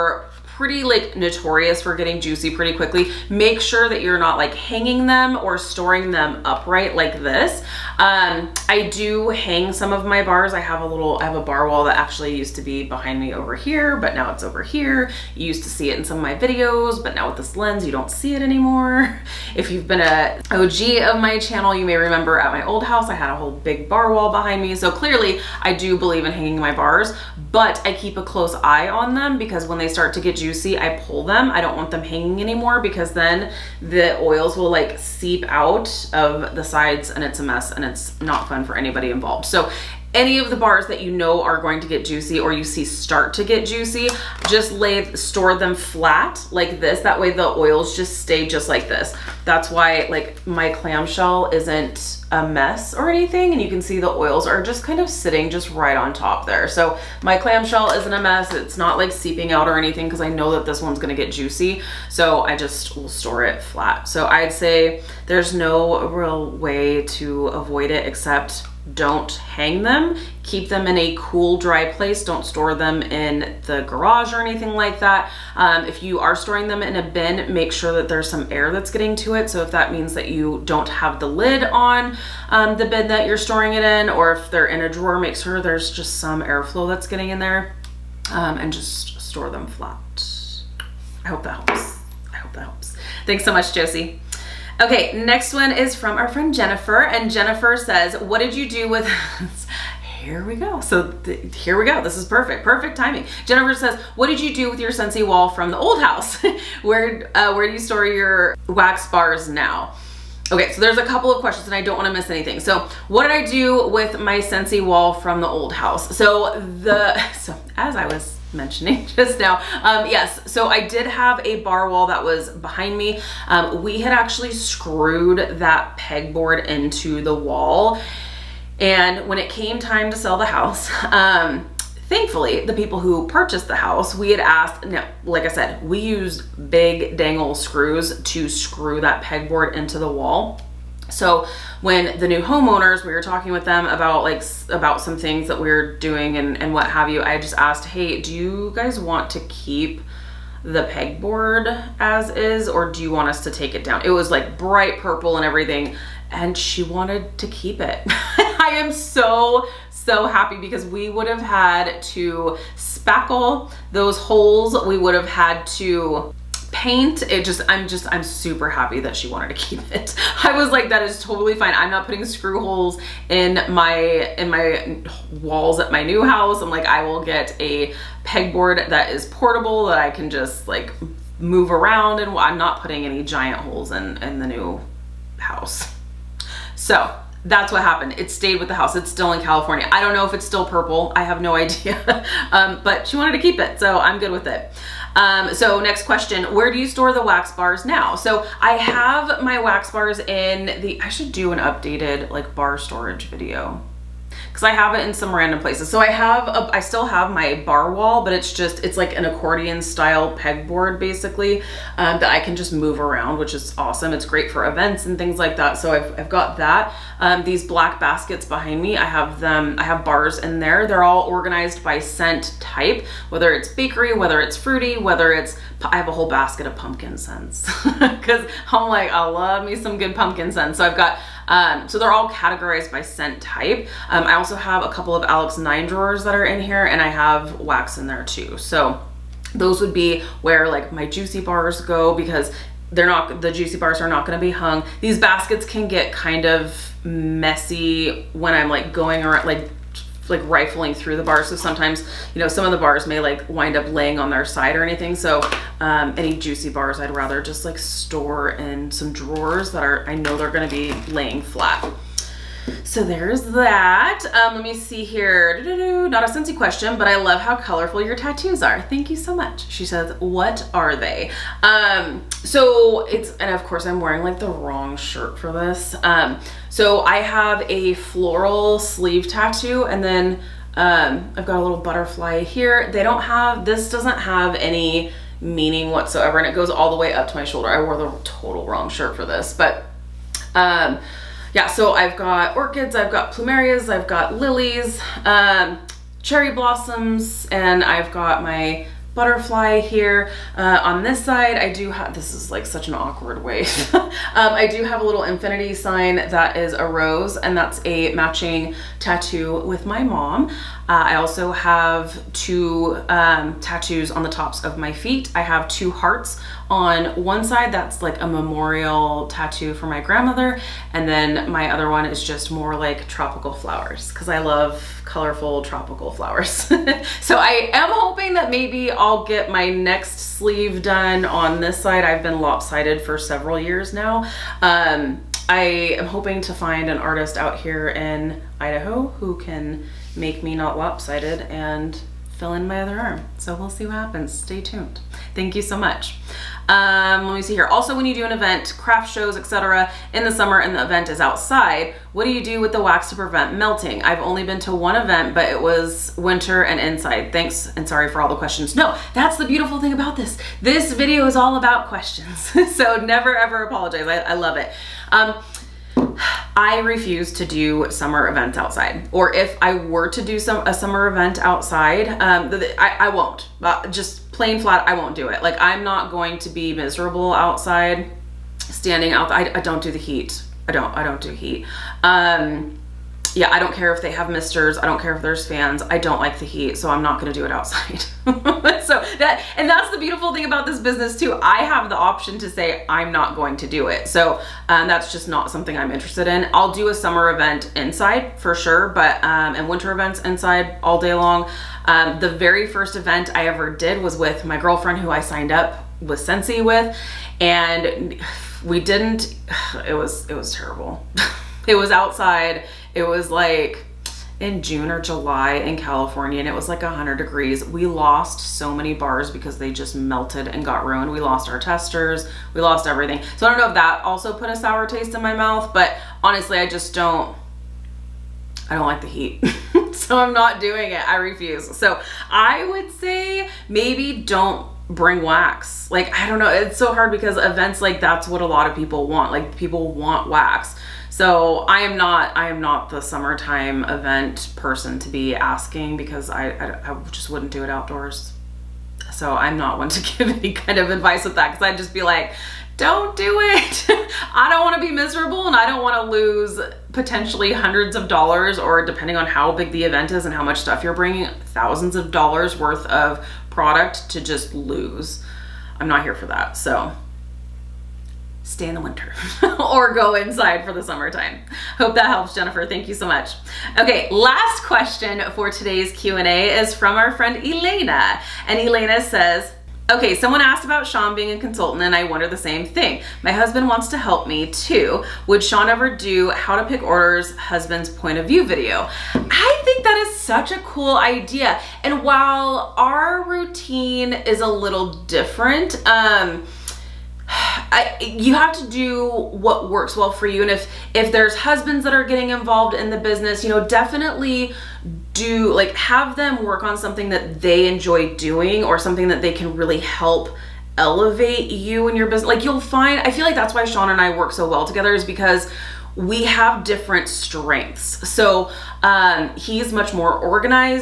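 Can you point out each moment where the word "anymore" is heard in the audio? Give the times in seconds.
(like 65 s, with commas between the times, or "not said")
18 s, 32 s.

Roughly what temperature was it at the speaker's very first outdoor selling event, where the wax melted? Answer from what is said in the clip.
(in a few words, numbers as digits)
100 degrees.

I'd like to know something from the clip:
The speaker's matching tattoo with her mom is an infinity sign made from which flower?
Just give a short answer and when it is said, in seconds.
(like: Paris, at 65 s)
Rose, at 306 s.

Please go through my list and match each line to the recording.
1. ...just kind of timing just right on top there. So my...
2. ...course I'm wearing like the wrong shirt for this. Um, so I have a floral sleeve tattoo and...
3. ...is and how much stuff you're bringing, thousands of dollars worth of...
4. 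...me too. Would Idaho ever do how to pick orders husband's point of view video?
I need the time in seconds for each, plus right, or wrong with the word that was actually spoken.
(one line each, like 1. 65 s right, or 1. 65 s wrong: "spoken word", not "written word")
1. 54 s wrong: "sitting", not "timing"
2. 273 s right
3. 460 s right
4. 484 s wrong: "Sean", not "Idaho".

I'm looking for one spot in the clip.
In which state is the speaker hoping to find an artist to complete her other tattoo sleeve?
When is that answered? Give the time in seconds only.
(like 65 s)
338 s.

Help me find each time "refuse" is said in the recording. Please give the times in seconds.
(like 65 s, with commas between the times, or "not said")
366 s, 431 s.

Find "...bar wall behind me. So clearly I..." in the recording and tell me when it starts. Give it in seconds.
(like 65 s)
23 s.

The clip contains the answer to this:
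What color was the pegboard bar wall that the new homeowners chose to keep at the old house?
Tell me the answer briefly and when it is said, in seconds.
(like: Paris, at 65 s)
Bright purple, at 154 s.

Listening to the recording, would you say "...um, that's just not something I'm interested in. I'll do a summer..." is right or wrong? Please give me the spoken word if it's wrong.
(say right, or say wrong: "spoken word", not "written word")
right.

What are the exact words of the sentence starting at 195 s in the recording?
Um, so next question, where do you store the wax bars now?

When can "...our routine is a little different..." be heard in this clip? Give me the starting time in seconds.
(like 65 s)
492 s.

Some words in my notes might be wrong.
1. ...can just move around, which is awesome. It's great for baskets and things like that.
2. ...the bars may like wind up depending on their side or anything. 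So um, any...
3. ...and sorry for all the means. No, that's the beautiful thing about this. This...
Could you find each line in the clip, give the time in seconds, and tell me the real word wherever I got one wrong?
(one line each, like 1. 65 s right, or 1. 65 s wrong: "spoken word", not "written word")
1. 212 s wrong: "events", not "baskets"
2. 252 s wrong: "laying", not "depending"
3. 357 s wrong: "questions", not "means".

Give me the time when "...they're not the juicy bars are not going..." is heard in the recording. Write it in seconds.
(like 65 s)
242 s.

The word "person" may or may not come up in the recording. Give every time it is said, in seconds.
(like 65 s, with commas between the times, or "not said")
444 s.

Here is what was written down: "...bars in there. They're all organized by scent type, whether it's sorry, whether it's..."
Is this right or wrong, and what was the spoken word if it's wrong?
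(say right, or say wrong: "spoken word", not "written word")
wrong: "bakery", not "sorry".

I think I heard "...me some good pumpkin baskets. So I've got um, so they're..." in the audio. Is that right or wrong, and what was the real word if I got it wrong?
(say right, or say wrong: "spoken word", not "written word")
wrong: "scents", not "baskets".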